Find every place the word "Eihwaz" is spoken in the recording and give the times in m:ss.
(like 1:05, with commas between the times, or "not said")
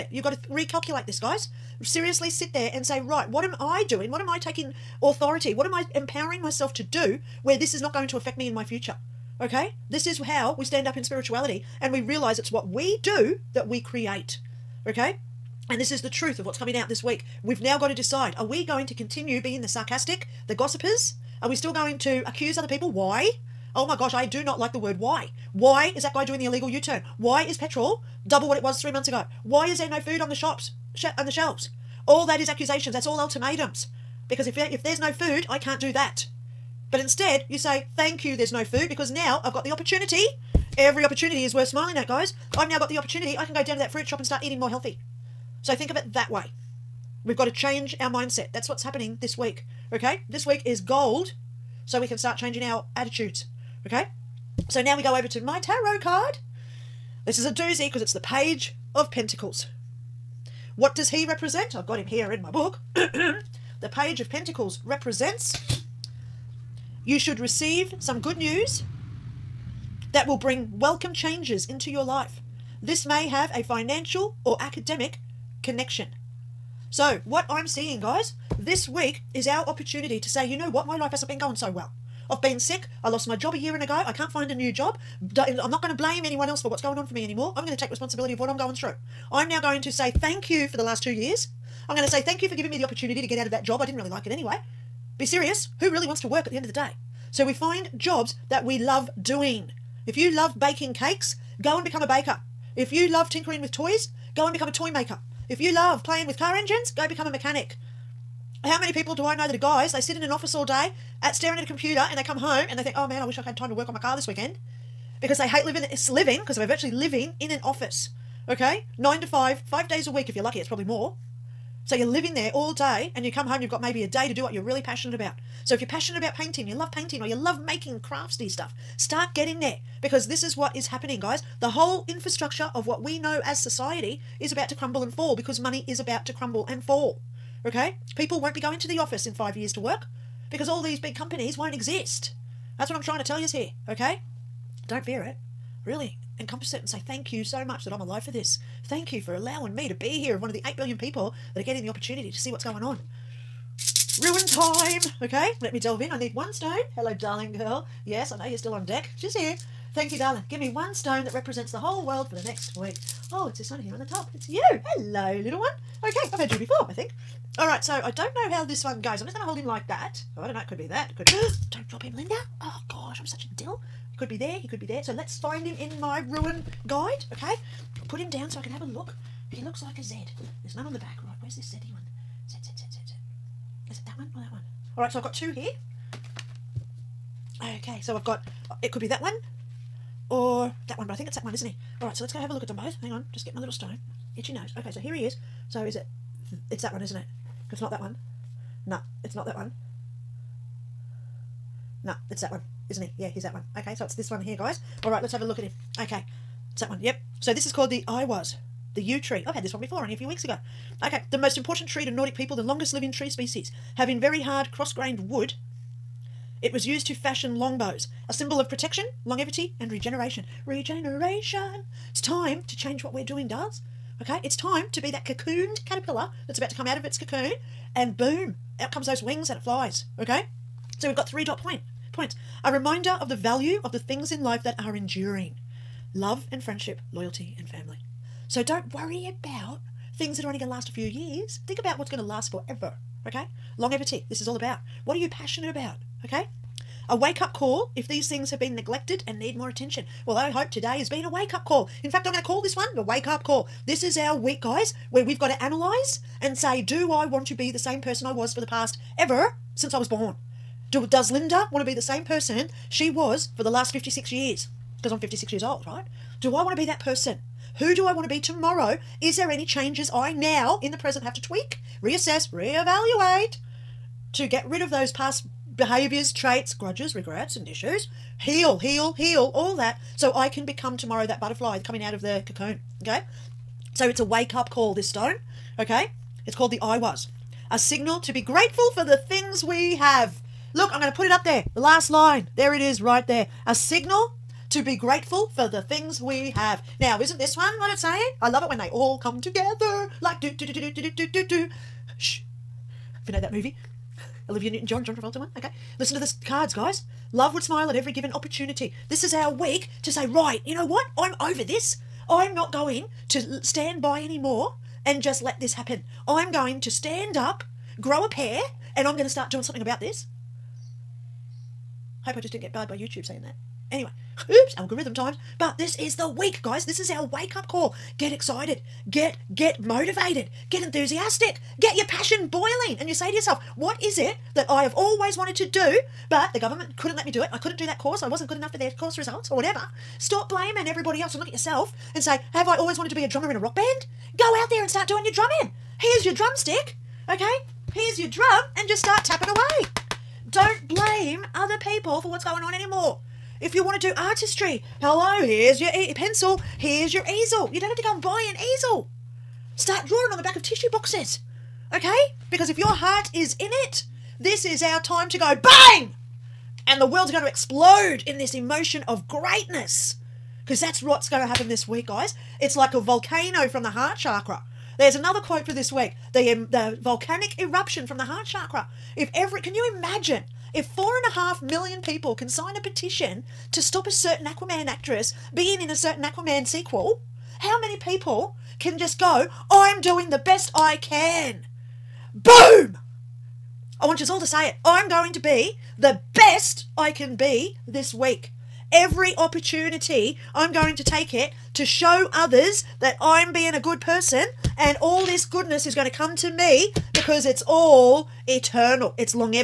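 3:28, 4:46.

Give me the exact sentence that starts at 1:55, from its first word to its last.
Because they hate living, living because we're virtually living in an office.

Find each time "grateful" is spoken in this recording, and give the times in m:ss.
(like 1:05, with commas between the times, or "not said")
4:48, 4:54.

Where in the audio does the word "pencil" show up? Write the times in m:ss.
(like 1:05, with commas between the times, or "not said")
5:56.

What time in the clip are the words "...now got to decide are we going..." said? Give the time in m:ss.
0:17.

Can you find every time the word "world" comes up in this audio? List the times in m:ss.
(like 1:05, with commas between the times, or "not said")
2:42, 6:07.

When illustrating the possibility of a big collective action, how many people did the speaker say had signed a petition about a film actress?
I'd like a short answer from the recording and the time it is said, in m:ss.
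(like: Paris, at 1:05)
4.5 million, at 6:20.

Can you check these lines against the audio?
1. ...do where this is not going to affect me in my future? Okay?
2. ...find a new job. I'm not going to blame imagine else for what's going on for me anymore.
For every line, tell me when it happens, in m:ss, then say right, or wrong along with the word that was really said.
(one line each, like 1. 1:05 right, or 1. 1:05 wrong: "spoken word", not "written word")
1. 0:06 right
2. 1:24 wrong: "anyone", not "imagine".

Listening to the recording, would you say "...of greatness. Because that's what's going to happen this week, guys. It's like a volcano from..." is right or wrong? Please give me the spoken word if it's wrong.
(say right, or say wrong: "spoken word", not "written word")
right.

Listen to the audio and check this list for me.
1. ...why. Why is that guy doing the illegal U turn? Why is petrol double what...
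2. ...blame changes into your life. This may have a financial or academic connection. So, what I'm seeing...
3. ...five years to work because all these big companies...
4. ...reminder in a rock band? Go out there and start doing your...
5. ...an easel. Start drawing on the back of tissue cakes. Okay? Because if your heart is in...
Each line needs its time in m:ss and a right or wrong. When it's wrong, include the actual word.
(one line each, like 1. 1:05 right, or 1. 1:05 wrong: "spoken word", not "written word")
1. 0:25 right
2. 1:10 wrong: "welcome", not "blame"
3. 2:19 right
4. 5:43 wrong: "drummer", not "reminder"
5. 5:58 wrong: "boxes", not "cakes".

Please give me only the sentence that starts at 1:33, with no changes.
I didn't really like it anyway.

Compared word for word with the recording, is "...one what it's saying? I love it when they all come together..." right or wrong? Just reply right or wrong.
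right.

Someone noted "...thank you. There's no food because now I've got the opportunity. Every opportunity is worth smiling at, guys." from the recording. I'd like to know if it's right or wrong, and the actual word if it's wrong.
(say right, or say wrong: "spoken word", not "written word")
right.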